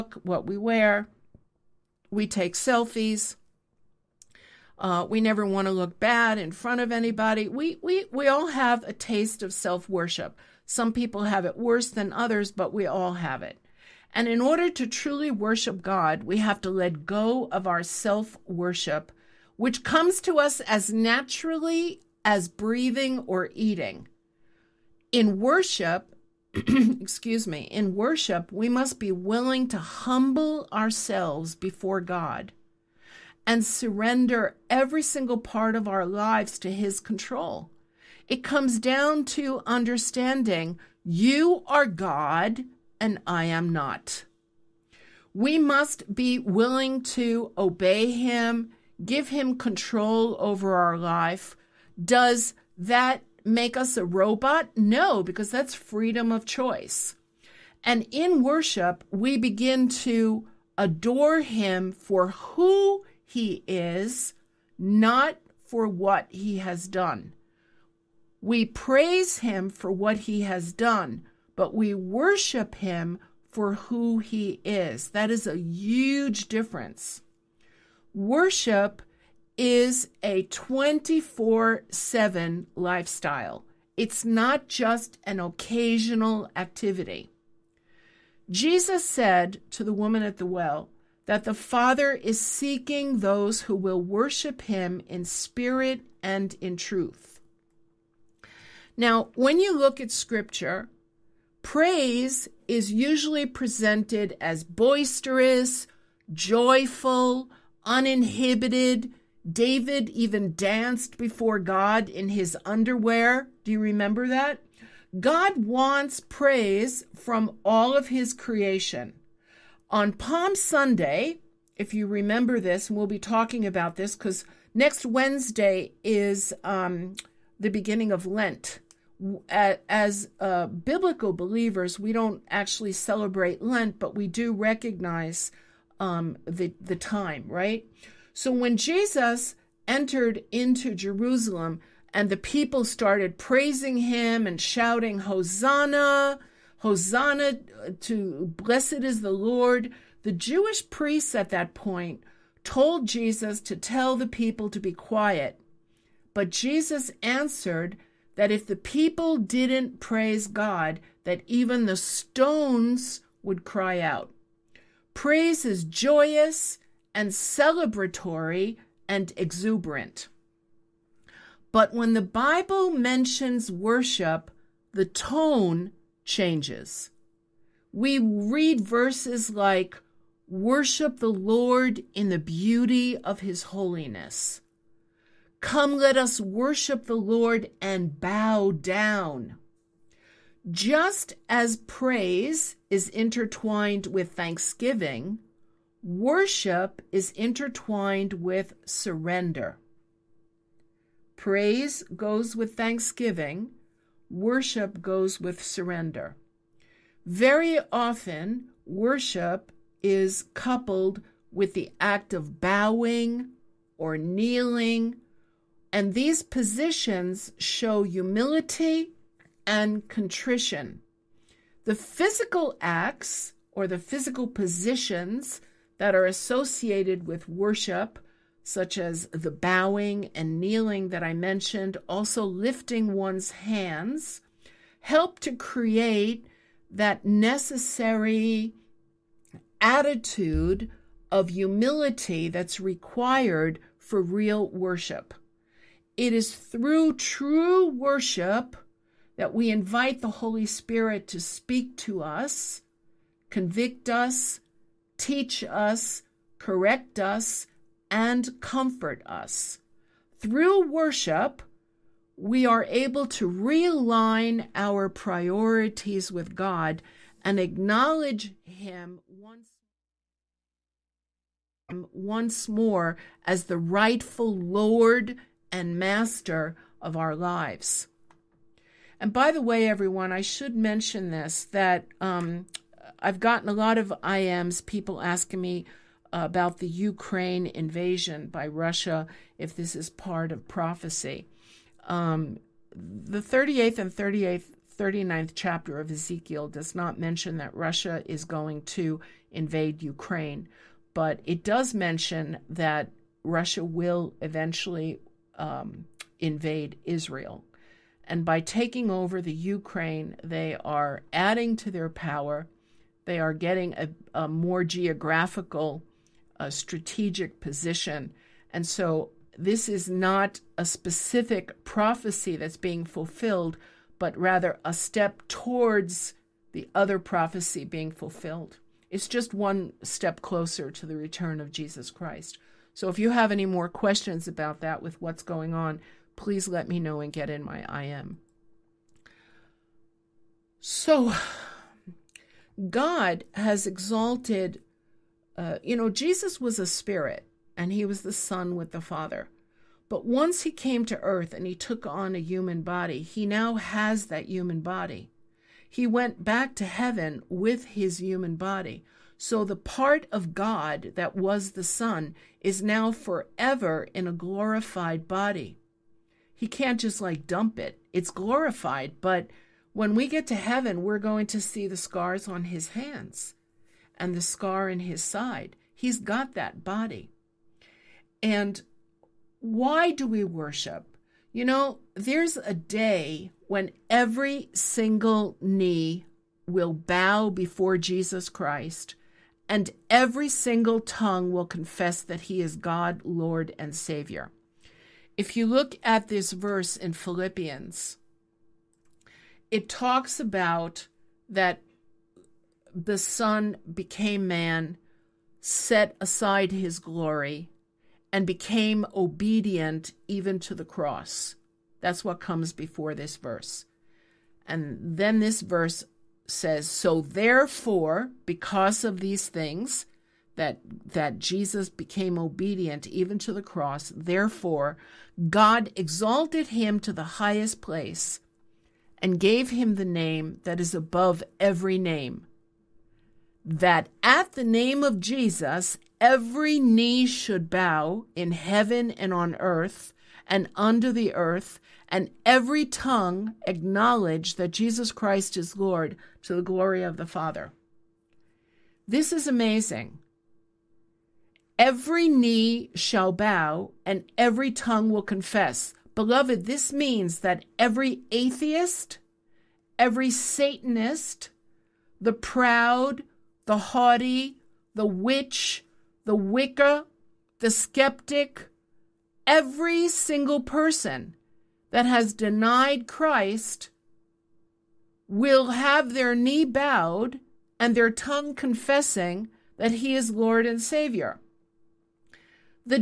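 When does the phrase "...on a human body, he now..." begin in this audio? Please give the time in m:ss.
5:52.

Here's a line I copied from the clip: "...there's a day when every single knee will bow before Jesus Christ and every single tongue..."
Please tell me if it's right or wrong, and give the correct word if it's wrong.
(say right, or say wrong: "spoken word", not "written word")
right.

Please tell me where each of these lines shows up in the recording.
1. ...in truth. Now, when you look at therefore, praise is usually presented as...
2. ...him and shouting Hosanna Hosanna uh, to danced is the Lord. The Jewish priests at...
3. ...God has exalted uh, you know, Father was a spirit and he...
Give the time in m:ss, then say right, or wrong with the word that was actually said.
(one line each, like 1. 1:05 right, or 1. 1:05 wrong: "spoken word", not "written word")
1. 1:36 wrong: "scripture", not "therefore"
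2. 2:23 wrong: "blessed", not "danced"
3. 5:42 wrong: "Jesus", not "Father".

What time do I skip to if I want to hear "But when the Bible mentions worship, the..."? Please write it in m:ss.
2:51.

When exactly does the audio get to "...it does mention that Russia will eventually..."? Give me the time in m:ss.
5:01.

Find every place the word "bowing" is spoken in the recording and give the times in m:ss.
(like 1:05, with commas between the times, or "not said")
3:32, 3:49.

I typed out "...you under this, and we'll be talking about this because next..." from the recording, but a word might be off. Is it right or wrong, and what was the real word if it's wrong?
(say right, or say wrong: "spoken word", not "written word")
wrong: "remember", not "under".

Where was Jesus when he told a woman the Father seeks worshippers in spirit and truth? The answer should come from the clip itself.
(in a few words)
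The well.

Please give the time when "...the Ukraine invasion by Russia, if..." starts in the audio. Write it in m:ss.
4:46.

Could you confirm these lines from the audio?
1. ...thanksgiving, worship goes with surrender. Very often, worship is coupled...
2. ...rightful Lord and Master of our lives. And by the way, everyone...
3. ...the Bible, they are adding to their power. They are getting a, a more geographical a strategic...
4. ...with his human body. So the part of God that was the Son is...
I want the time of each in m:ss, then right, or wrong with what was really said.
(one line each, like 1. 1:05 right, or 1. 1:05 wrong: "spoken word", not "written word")
1. 3:22 right
2. 4:33 right
3. 5:09 wrong: "Ukraine", not "Bible"
4. 5:57 right.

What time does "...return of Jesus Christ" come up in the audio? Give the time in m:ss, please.
5:31.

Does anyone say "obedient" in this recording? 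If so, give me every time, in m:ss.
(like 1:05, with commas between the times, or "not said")
6:49, 7:02.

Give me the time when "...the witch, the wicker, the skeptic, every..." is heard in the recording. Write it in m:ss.
7:44.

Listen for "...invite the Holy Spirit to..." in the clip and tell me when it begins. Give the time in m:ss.
4:09.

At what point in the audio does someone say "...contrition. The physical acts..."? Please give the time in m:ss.
3:40.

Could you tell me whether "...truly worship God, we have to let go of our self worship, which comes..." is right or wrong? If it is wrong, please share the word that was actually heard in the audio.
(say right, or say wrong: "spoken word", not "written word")
right.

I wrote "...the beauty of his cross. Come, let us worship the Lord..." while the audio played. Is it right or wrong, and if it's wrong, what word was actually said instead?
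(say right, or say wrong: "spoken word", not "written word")
wrong: "holiness", not "cross".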